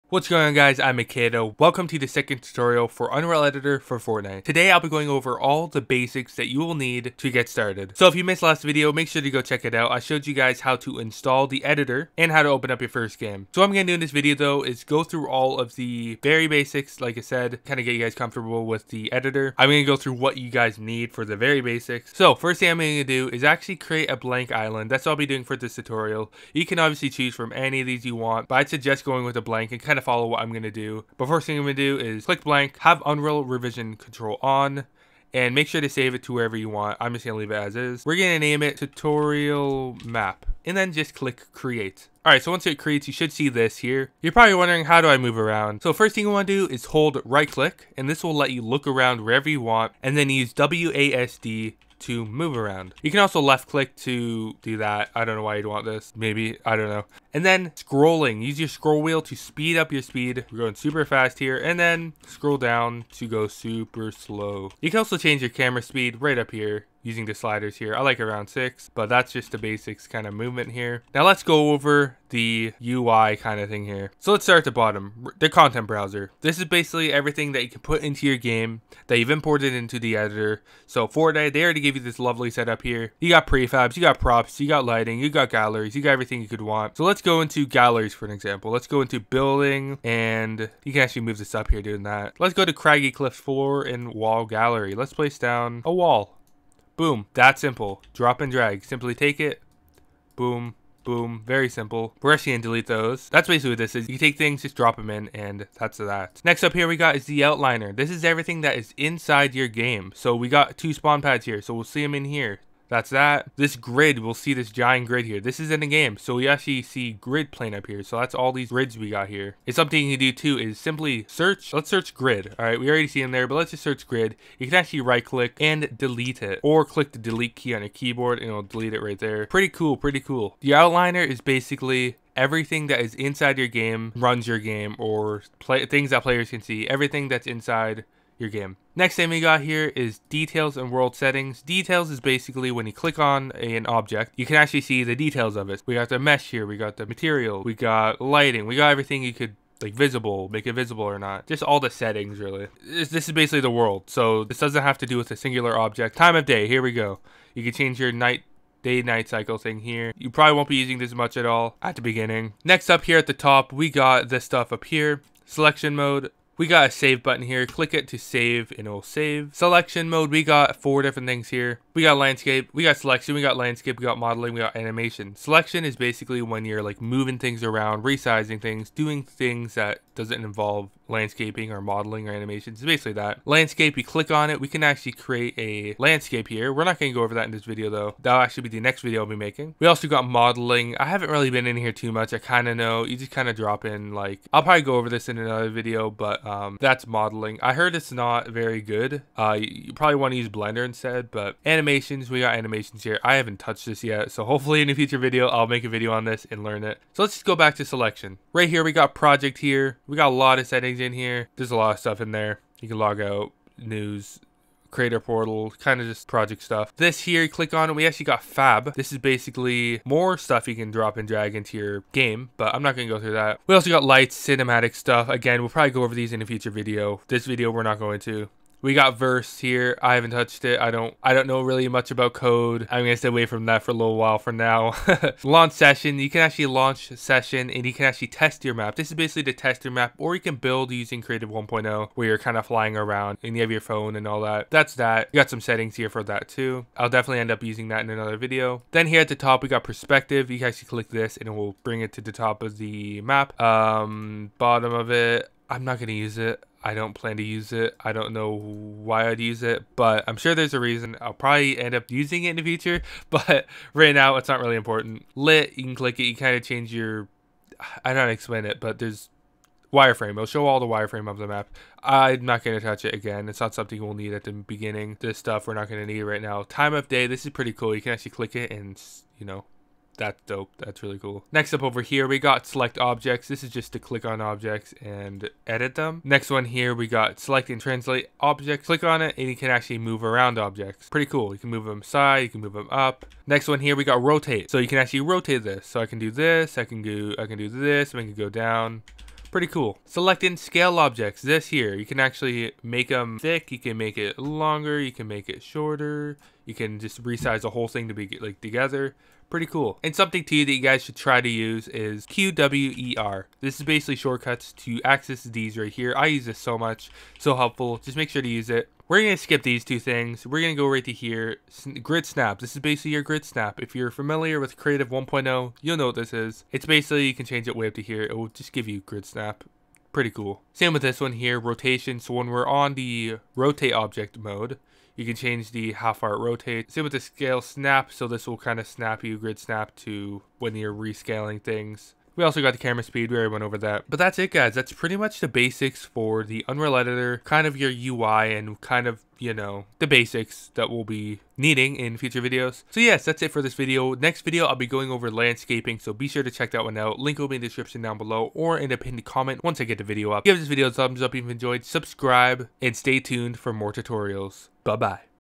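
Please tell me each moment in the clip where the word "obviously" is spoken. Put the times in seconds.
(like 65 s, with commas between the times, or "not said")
26 s.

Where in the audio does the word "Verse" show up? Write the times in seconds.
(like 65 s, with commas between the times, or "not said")
229 s.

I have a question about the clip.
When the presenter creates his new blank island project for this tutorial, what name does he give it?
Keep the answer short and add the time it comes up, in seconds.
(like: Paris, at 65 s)
tutorial map, at 38 s.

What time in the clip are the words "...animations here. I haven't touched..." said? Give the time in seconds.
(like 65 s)
202 s.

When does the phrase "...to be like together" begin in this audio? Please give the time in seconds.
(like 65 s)
308 s.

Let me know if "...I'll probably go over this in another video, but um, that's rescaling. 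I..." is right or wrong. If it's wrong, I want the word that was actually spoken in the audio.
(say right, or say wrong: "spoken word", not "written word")
wrong: "modeling", not "rescaling".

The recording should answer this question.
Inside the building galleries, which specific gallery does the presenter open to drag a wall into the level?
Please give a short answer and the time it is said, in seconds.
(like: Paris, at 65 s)
Craggy Cliff 4, at 92 s.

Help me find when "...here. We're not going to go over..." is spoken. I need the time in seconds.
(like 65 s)
186 s.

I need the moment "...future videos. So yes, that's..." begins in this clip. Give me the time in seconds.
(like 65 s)
352 s.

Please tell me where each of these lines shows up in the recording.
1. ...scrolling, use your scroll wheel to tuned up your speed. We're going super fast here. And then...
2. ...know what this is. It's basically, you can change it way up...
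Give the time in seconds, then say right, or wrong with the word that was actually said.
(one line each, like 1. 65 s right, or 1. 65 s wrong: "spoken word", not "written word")
1. 57 s wrong: "speed", not "tuned"
2. 325 s right.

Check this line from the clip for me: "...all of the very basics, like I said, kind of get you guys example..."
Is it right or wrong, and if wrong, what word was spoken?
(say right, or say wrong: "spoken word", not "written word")
wrong: "comfortable", not "example".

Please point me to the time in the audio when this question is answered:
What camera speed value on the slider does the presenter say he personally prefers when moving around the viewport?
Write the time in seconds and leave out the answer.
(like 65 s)
68 s.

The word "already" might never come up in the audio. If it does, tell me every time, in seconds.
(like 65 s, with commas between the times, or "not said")
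81 s, 122 s, 343 s.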